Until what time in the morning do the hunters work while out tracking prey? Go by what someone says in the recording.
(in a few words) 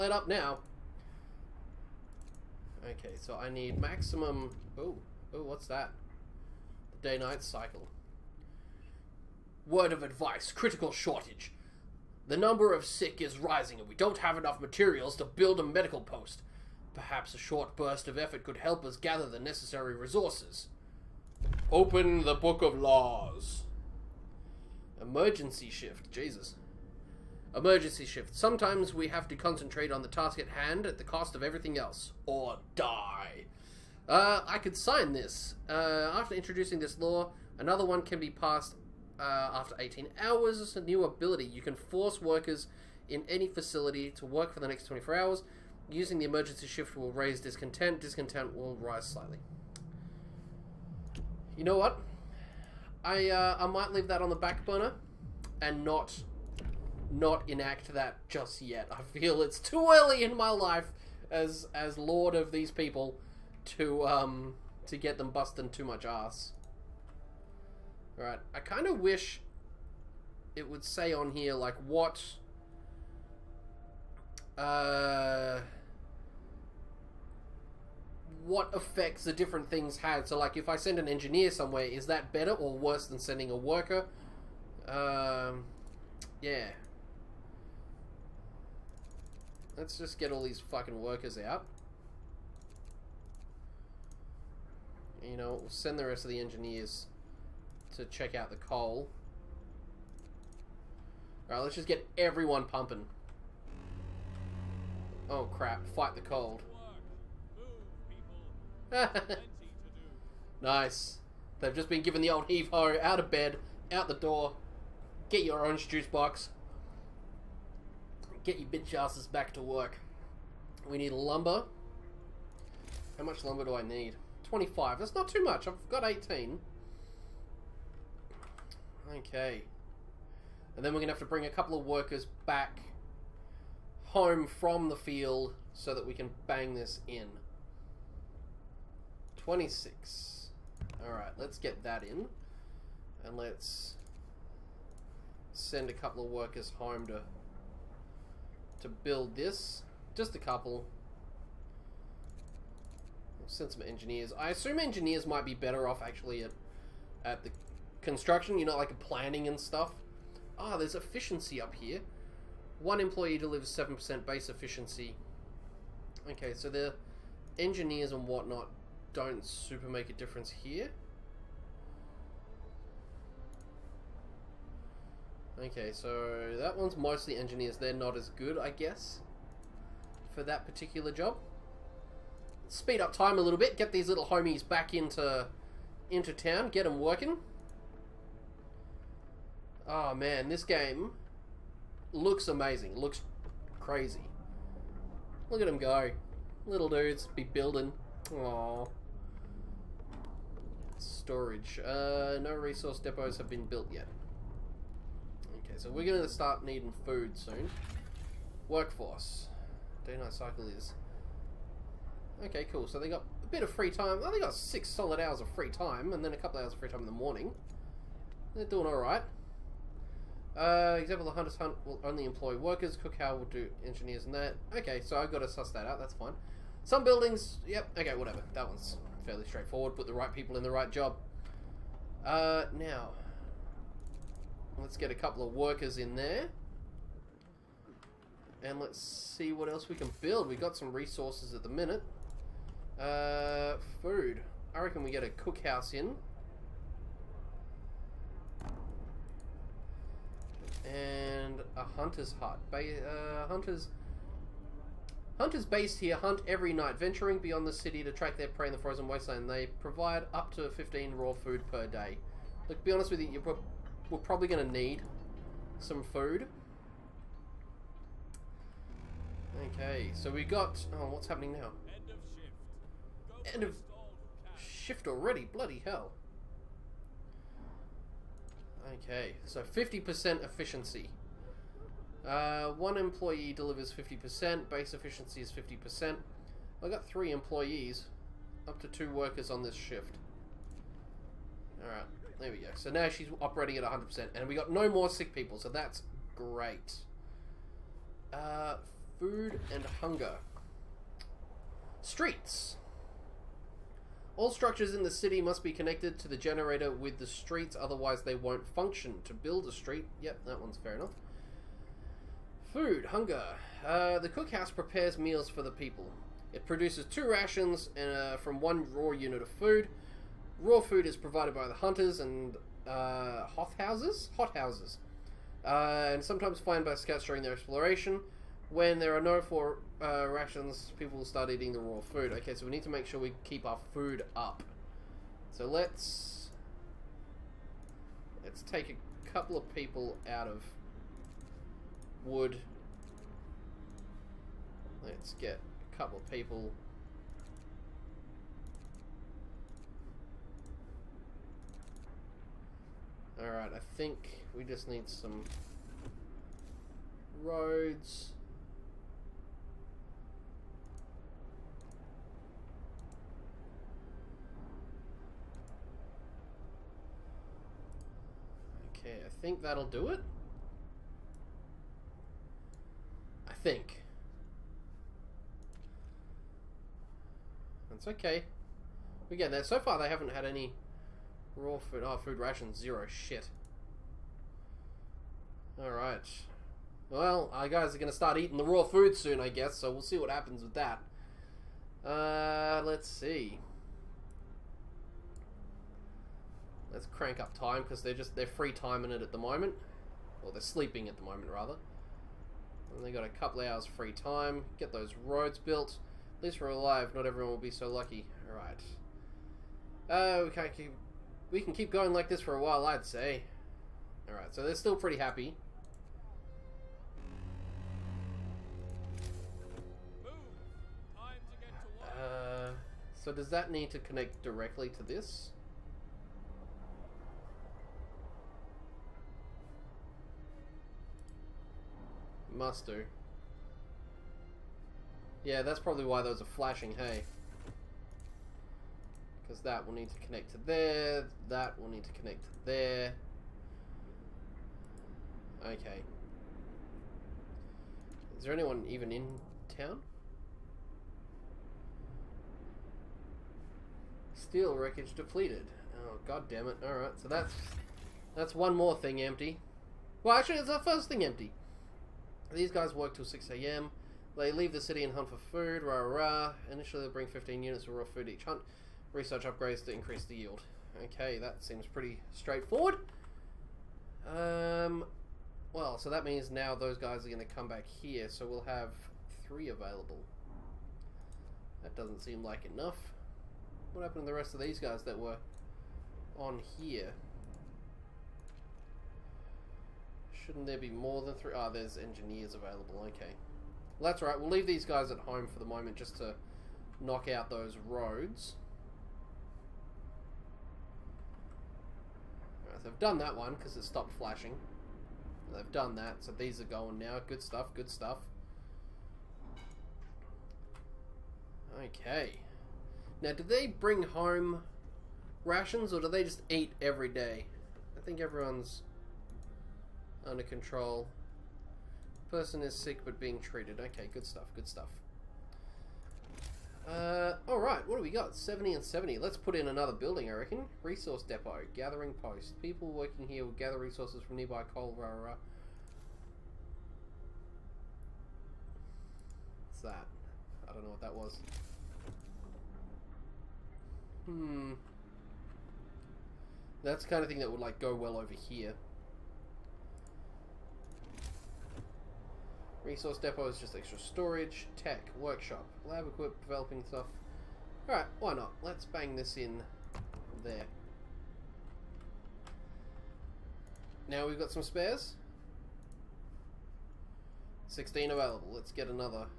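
6 a.m.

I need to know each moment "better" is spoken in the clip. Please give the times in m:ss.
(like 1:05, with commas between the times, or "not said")
1:22, 2:35.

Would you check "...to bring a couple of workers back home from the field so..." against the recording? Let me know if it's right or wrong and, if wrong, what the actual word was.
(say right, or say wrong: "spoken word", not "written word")
right.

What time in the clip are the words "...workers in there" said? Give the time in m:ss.
3:55.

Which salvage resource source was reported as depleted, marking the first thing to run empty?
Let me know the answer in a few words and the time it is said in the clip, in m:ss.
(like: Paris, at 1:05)
Steel wreckage, at 7:34.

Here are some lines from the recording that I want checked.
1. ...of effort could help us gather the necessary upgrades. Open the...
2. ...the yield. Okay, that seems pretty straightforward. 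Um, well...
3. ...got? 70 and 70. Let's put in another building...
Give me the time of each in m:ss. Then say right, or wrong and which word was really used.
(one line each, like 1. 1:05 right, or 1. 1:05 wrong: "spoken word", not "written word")
1. 0:18 wrong: "resources", not "upgrades"
2. 7:50 right
3. 8:48 right.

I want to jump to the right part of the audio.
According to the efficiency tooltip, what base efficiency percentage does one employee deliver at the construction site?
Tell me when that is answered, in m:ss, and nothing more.
2:43.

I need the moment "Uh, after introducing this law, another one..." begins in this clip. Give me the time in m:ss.
0:35.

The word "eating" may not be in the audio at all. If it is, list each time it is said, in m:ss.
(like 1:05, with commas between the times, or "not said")
5:31, 6:28.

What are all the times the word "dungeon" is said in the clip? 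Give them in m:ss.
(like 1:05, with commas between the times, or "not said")
not said.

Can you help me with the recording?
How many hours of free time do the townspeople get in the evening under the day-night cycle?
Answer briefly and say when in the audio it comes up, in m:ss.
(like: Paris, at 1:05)
six, at 3:34.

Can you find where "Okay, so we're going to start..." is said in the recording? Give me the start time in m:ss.
3:25.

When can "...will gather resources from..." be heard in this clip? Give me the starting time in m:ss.
8:53.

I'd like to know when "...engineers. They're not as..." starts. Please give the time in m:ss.
2:57.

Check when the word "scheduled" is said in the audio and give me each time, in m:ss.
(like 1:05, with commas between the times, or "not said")
not said.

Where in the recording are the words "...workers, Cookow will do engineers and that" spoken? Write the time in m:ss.
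3:42.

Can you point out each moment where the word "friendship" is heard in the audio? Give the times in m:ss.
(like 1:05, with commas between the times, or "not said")
not said.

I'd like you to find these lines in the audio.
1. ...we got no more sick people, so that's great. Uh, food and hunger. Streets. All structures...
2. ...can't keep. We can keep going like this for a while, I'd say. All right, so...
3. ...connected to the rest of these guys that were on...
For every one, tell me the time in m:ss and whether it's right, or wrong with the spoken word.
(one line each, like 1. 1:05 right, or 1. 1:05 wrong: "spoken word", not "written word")
1. 4:54 right
2. 6:50 right
3. 8:04 wrong: "happened", not "connected".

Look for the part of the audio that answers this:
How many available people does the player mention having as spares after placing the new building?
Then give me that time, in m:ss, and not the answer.
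9:27.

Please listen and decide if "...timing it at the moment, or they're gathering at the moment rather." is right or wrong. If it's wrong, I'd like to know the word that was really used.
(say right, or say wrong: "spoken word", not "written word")
wrong: "sleeping", not "gathering".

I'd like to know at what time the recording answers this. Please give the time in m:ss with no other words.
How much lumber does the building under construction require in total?
2:04.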